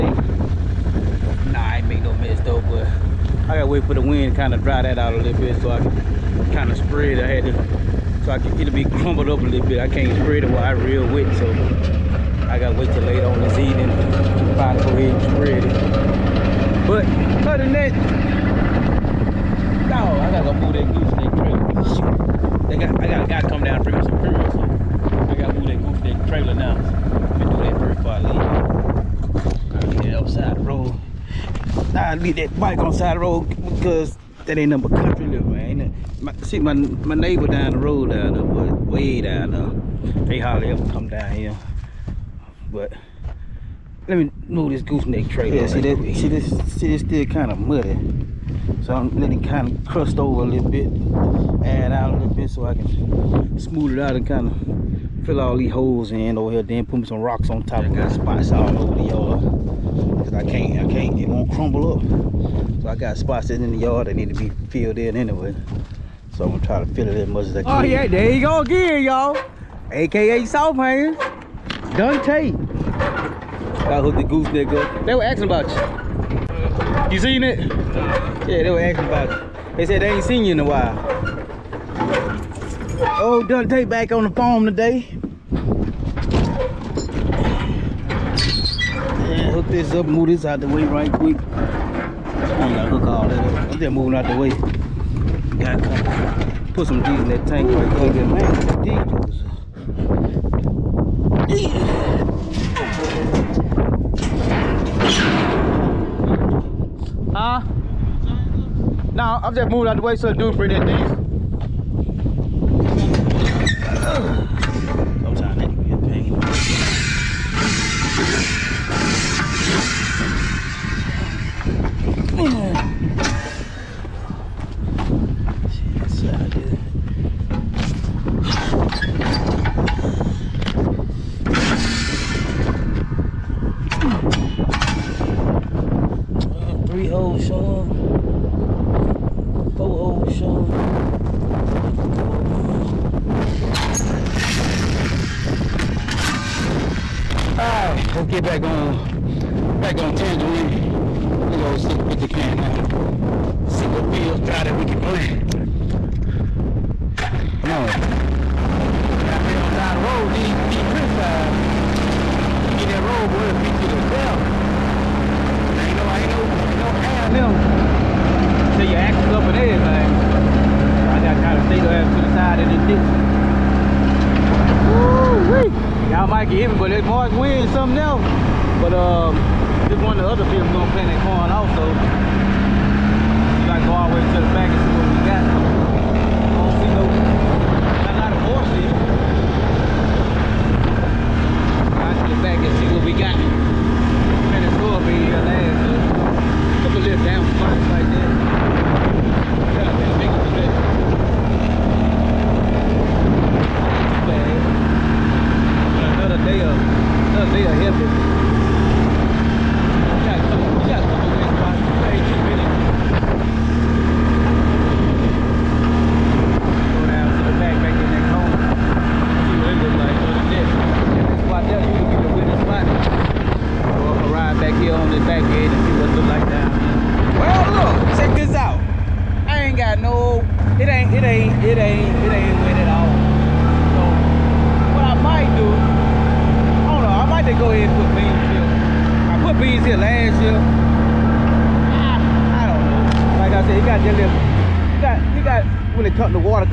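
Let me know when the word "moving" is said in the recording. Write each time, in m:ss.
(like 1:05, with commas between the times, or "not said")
1:33, 1:49.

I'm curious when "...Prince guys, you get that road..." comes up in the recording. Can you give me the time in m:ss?
2:40.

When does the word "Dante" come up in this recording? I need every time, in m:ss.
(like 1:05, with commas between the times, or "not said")
1:11, 1:23.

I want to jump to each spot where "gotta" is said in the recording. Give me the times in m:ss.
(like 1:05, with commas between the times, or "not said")
0:12, 0:20, 0:25, 2:39, 3:03.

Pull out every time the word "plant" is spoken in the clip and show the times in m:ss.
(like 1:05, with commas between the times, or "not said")
2:35, 3:00.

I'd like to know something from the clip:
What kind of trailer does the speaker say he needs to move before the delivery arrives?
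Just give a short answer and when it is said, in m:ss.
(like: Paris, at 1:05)
Gooseneck trailer, at 0:44.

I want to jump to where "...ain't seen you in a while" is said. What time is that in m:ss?
1:20.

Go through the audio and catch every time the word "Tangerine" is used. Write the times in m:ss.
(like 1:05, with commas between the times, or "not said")
2:30.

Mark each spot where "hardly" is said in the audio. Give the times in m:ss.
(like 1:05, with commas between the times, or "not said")
0:40.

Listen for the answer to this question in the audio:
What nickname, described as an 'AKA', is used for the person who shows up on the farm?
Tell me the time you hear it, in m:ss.
1:10.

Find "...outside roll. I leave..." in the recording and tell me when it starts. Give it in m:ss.
0:30.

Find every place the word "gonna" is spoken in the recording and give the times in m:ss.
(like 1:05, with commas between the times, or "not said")
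0:27, 1:06, 1:32, 3:00.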